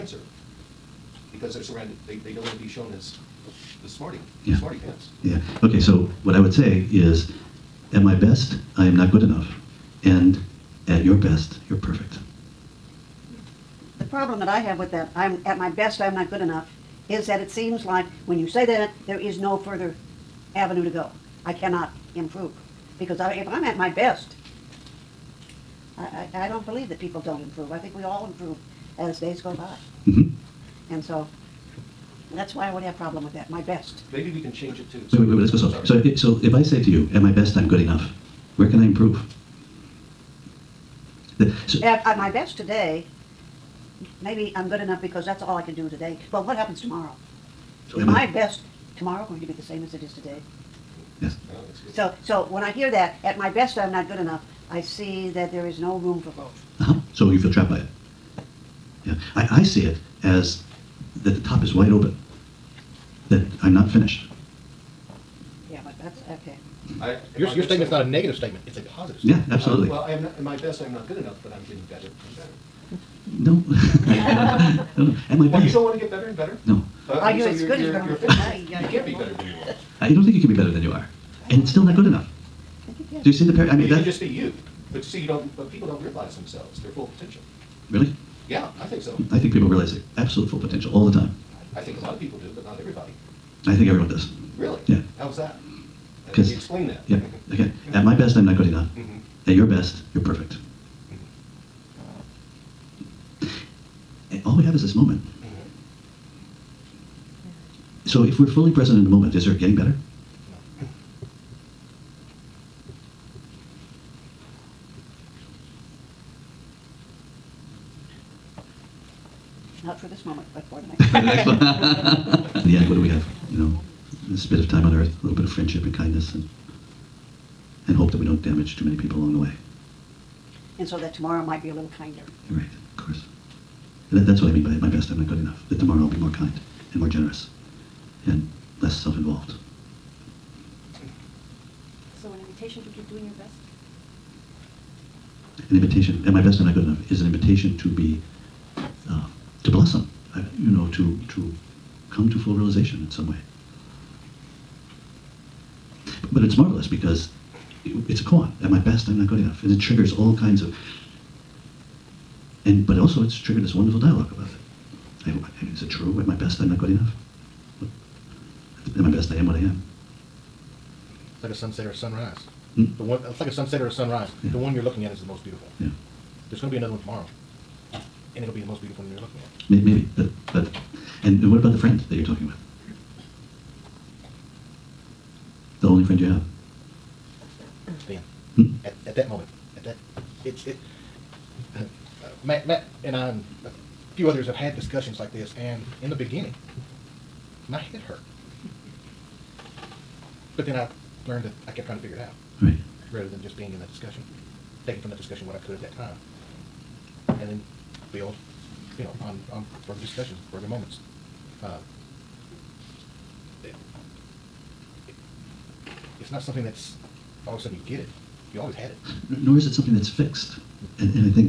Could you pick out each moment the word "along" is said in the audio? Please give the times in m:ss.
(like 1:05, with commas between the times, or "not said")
2:09.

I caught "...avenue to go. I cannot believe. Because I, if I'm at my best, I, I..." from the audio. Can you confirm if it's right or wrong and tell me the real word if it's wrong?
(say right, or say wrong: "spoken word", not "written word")
wrong: "improve", not "believe".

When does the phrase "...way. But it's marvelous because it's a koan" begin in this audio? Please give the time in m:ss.
2:33.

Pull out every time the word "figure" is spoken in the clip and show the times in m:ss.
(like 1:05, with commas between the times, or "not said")
3:21.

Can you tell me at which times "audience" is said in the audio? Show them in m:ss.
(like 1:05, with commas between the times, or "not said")
not said.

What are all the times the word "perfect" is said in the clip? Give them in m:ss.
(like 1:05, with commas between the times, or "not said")
0:11, 1:40.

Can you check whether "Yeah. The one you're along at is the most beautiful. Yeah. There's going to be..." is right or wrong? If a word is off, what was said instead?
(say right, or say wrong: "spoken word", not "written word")
wrong: "looking", not "along".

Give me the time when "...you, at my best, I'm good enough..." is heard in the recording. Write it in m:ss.
0:36.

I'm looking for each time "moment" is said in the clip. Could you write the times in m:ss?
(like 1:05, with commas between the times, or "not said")
1:44, 1:49, 2:00, 3:09, 3:30.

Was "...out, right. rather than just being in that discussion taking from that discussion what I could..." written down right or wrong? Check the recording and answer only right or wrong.
right.